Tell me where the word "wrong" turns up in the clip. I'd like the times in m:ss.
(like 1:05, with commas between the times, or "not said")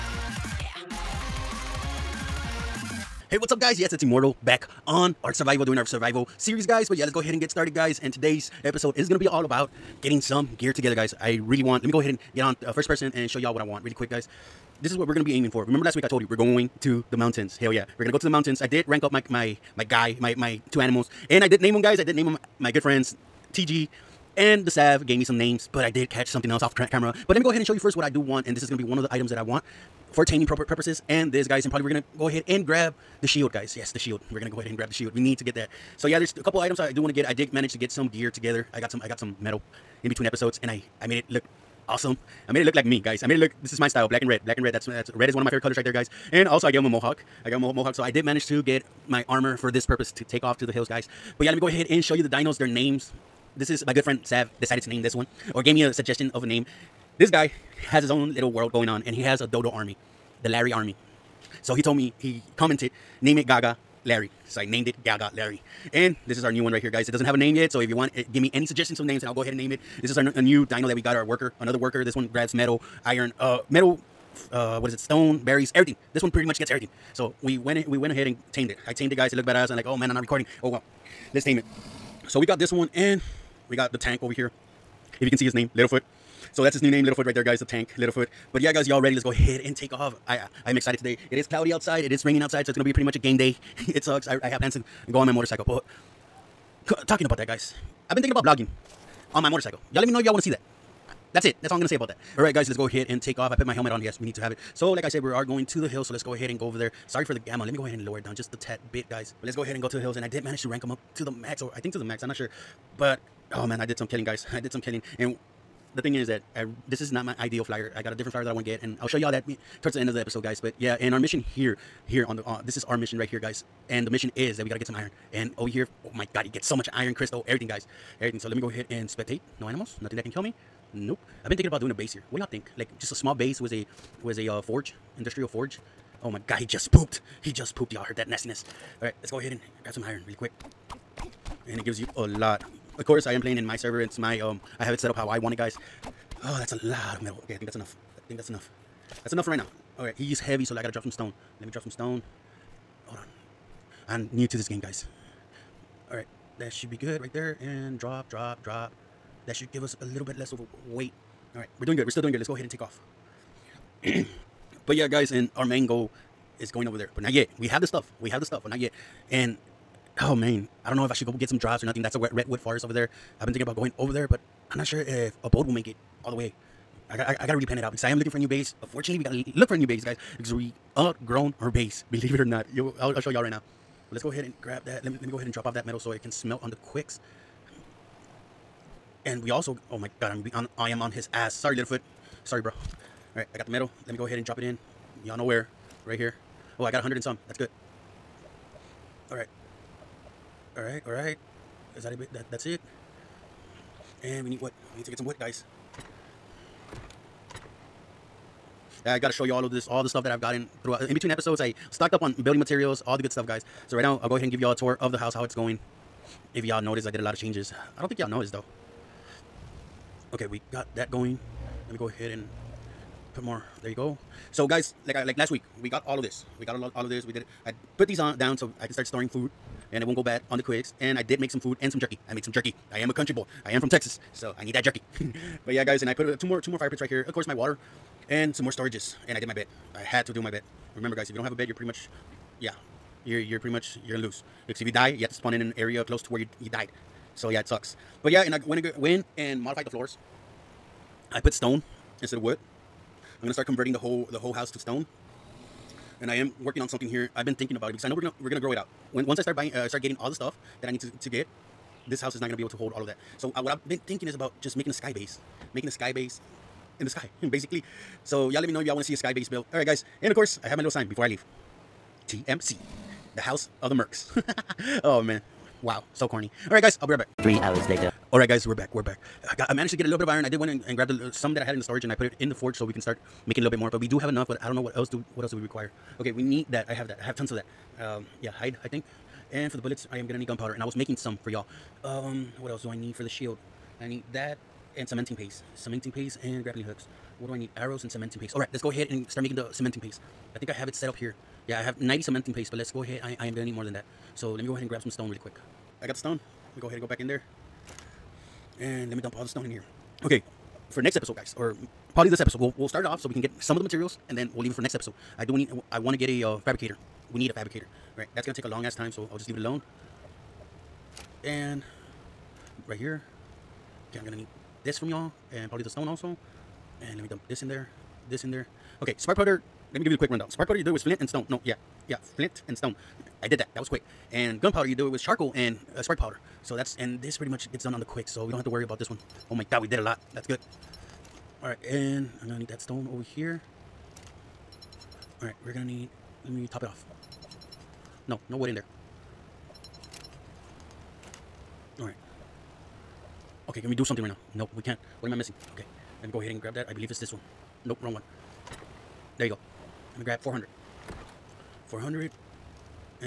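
5:58.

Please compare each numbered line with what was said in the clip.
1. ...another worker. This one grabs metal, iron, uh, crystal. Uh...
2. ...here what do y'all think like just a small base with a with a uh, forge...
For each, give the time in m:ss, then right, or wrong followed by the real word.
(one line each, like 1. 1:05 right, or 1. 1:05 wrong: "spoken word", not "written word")
1. 1:11 wrong: "metal", not "crystal"
2. 2:12 right.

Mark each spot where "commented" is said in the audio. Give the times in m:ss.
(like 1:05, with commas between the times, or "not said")
1:02.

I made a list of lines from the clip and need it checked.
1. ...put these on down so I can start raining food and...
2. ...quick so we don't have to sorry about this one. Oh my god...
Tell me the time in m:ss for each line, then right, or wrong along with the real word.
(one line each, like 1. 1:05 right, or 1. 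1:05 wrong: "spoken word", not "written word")
1. 3:47 wrong: "storing", not "raining"
2. 5:38 wrong: "worry", not "sorry".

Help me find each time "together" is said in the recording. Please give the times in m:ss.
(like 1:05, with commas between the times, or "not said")
0:10, 0:38.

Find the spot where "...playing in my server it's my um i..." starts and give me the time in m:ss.
2:23.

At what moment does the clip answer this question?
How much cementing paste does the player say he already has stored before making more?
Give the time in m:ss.
5:02.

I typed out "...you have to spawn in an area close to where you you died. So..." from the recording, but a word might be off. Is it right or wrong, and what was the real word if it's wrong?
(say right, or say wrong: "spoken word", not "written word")
right.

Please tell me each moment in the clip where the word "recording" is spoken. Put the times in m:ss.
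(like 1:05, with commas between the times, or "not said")
1:20.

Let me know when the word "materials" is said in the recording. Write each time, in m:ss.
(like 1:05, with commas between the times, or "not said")
3:32, 5:13.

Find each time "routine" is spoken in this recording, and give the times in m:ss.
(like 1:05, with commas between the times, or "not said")
not said.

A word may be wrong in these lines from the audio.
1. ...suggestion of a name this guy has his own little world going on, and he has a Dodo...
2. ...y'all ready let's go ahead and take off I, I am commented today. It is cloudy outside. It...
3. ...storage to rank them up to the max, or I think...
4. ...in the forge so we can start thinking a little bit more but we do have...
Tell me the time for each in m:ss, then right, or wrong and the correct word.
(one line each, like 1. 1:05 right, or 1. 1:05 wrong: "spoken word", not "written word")
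1. 0:55 right
2. 1:28 wrong: "excited", not "commented"
3. 1:50 wrong: "manage", not "storage"
4. 4:42 wrong: "making", not "thinking".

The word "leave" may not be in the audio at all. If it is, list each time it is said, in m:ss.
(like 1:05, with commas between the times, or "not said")
4:31, 5:14, 5:19.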